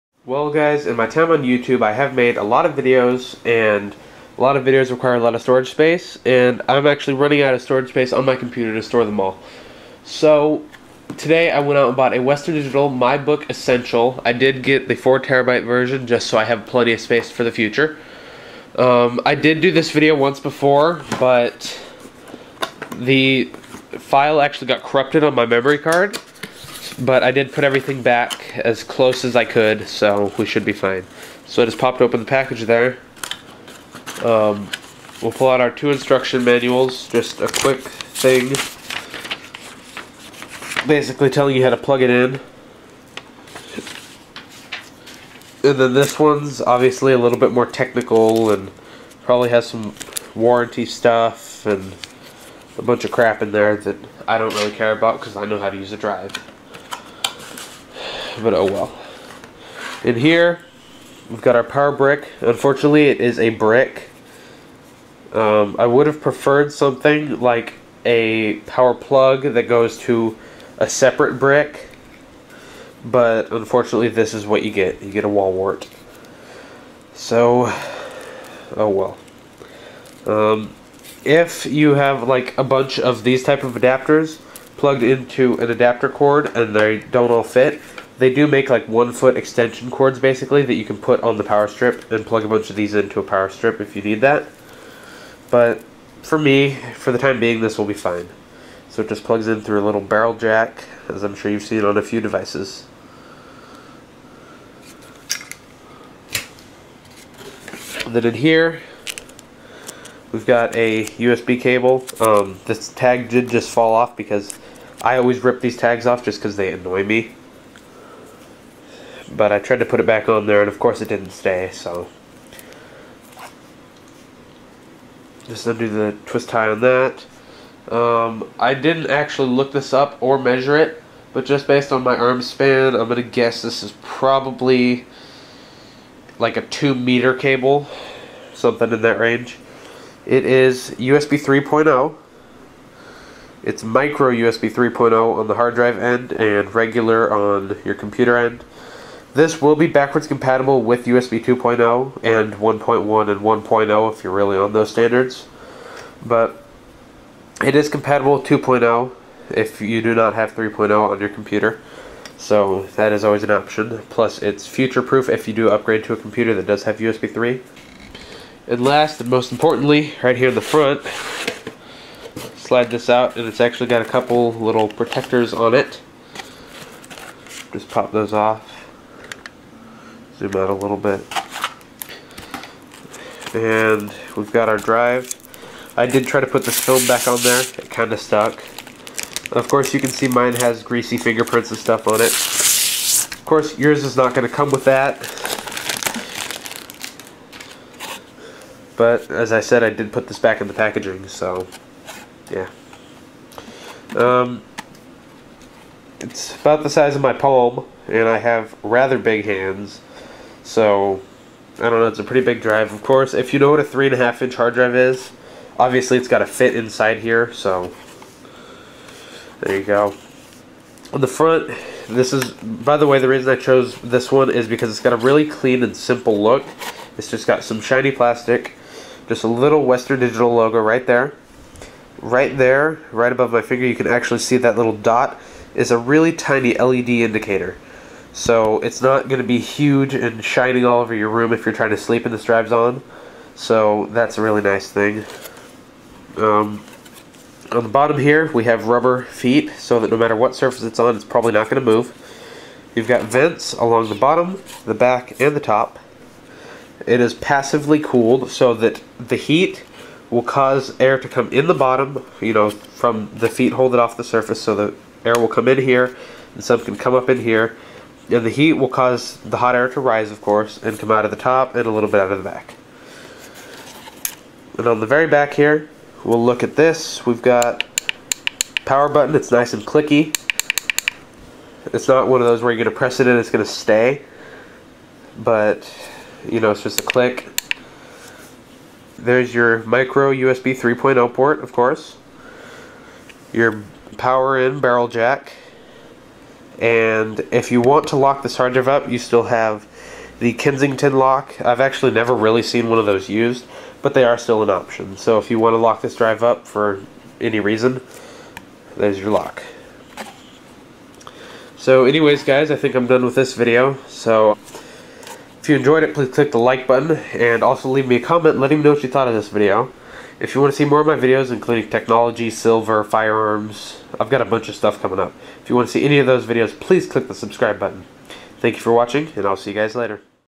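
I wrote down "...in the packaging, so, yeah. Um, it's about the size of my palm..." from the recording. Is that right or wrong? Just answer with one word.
right.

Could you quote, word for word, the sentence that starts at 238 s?
So it's not going to be huge and shining all over your room if you're trying to sleep and the strap's on.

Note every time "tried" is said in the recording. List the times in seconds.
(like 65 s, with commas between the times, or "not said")
119 s.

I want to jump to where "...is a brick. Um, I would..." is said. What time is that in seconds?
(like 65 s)
63 s.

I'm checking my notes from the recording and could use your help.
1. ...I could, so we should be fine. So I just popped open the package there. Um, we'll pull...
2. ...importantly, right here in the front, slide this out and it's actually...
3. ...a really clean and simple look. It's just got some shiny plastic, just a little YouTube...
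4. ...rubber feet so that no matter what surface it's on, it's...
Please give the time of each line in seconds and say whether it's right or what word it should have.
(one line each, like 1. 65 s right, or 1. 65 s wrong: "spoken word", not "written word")
1. 29 s right
2. 169 s right
3. 225 s wrong: "Western", not "YouTube"
4. 248 s right.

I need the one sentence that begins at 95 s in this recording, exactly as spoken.
But for me, for the time being, this will be fine.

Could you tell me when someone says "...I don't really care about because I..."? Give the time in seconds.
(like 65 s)
54 s.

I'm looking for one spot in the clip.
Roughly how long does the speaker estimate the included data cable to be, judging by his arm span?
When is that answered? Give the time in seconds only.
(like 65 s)
136 s.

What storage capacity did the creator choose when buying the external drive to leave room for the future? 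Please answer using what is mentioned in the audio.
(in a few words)
4 terabytes.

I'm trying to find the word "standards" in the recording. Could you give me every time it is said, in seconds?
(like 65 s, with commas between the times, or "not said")
154 s.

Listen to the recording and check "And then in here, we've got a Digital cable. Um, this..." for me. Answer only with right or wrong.
wrong.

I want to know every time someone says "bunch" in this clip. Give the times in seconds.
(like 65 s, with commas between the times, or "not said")
52 s, 82 s, 92 s, 324 s.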